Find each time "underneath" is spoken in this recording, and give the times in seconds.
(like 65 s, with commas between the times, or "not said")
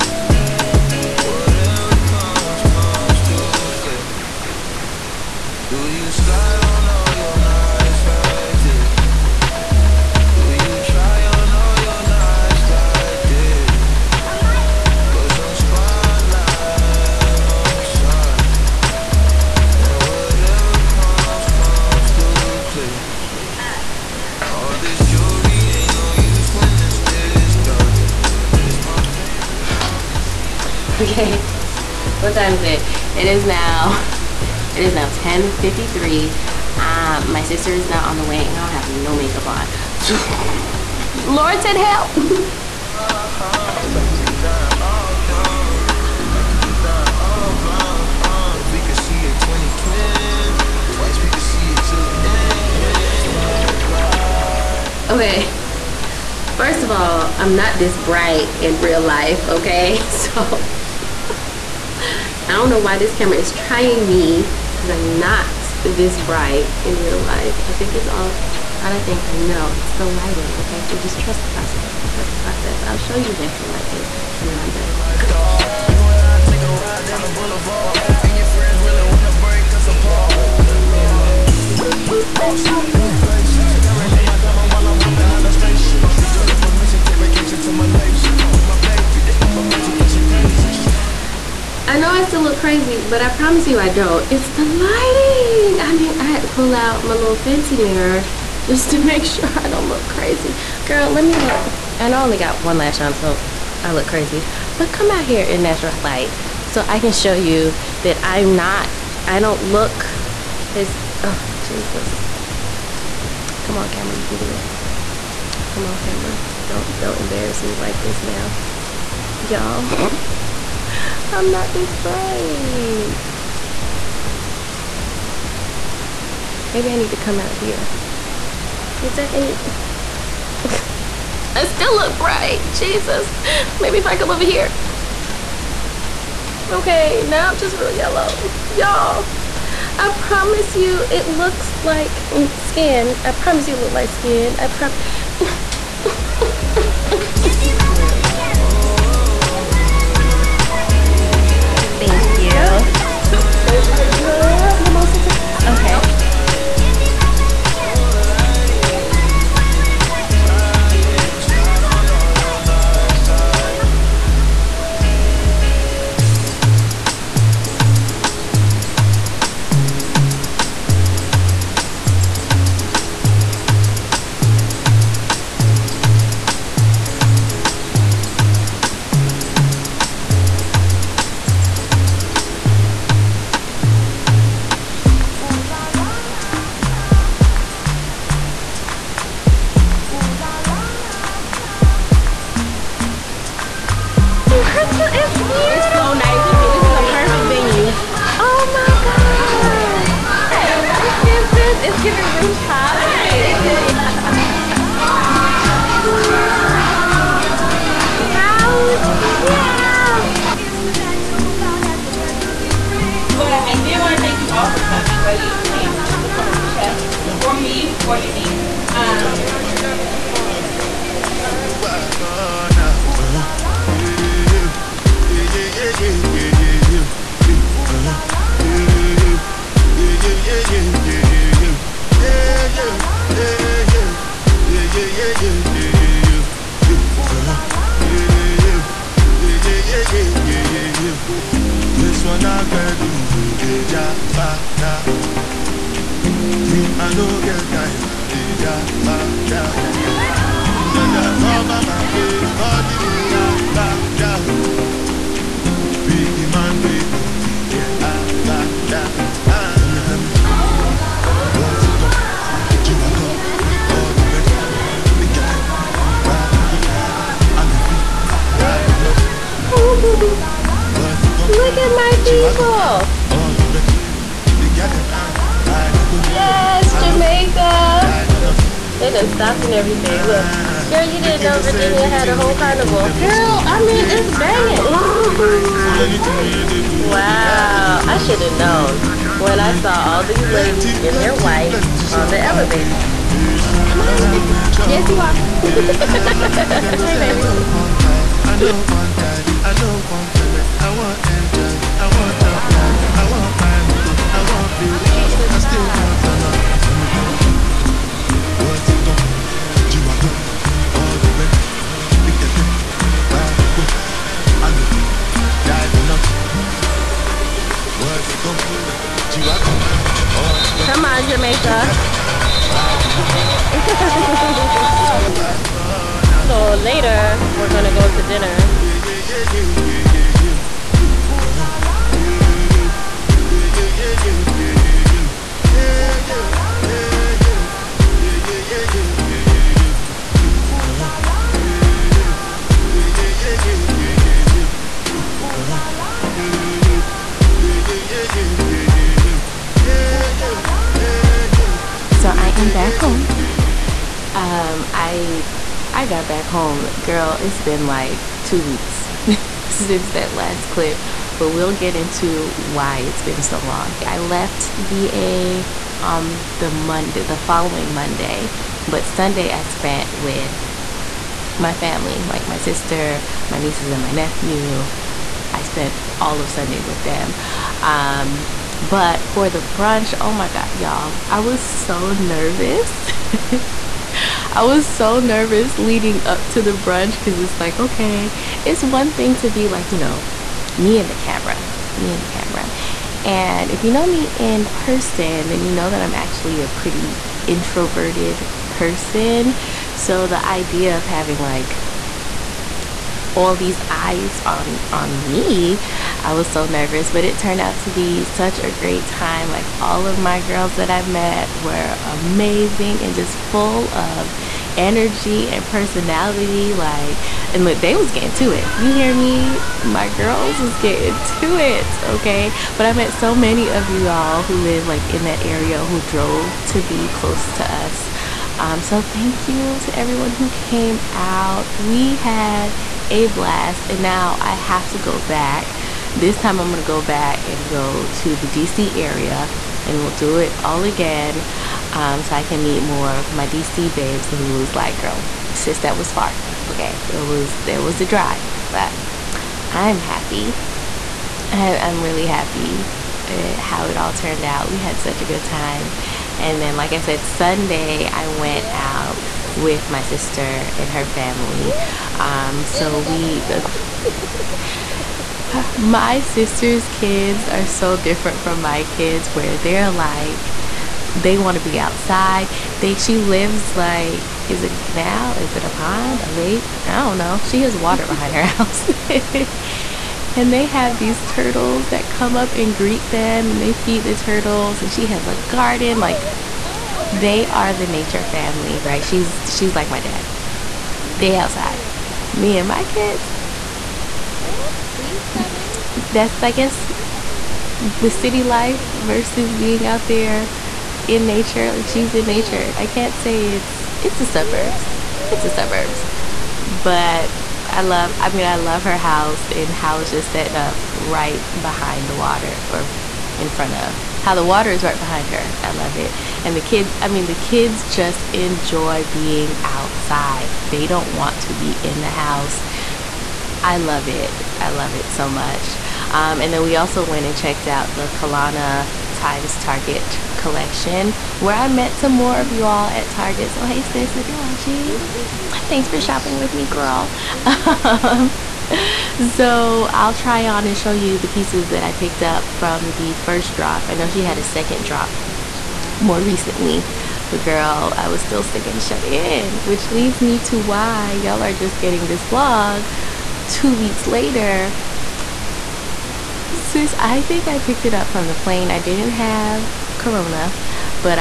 not said.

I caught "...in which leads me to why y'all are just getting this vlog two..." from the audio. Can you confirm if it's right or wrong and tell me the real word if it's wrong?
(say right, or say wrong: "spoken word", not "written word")
right.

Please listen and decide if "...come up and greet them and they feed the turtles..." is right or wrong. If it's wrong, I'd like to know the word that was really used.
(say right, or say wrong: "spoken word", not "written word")
right.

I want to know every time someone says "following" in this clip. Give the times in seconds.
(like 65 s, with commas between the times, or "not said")
367 s.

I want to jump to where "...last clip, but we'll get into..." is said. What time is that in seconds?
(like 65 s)
360 s.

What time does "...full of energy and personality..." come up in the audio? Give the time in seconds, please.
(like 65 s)
413 s.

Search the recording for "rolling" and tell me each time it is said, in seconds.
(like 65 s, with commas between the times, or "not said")
not said.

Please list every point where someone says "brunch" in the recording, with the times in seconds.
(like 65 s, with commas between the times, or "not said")
379 s, 386 s.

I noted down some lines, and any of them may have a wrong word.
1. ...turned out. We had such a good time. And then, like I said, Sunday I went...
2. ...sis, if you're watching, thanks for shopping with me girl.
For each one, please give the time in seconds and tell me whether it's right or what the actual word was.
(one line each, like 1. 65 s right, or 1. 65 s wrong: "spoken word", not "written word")
1. 454 s right
2. 533 s right.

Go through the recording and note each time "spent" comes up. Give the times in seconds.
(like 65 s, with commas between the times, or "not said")
369 s, 375 s.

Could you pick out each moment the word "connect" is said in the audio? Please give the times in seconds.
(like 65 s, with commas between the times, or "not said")
not said.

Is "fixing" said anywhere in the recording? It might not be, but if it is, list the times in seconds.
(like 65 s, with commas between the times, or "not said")
not said.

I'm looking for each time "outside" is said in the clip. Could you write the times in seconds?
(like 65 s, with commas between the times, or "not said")
471 s, 491 s, 519 s.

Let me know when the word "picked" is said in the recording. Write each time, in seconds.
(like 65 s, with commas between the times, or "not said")
541 s, 557 s.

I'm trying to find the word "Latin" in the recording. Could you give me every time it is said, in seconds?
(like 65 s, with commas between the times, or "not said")
not said.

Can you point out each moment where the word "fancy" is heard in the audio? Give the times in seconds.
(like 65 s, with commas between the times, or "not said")
97 s.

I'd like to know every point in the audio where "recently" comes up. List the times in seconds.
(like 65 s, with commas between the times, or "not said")
546 s.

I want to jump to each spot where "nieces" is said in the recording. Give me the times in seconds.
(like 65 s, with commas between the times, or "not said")
373 s.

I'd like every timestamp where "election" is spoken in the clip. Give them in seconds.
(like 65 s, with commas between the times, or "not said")
not said.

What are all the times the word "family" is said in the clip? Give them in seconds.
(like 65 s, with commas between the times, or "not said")
371 s, 461 s, 488 s.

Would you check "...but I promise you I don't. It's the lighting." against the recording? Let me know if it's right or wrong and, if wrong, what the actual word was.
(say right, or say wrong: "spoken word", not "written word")
right.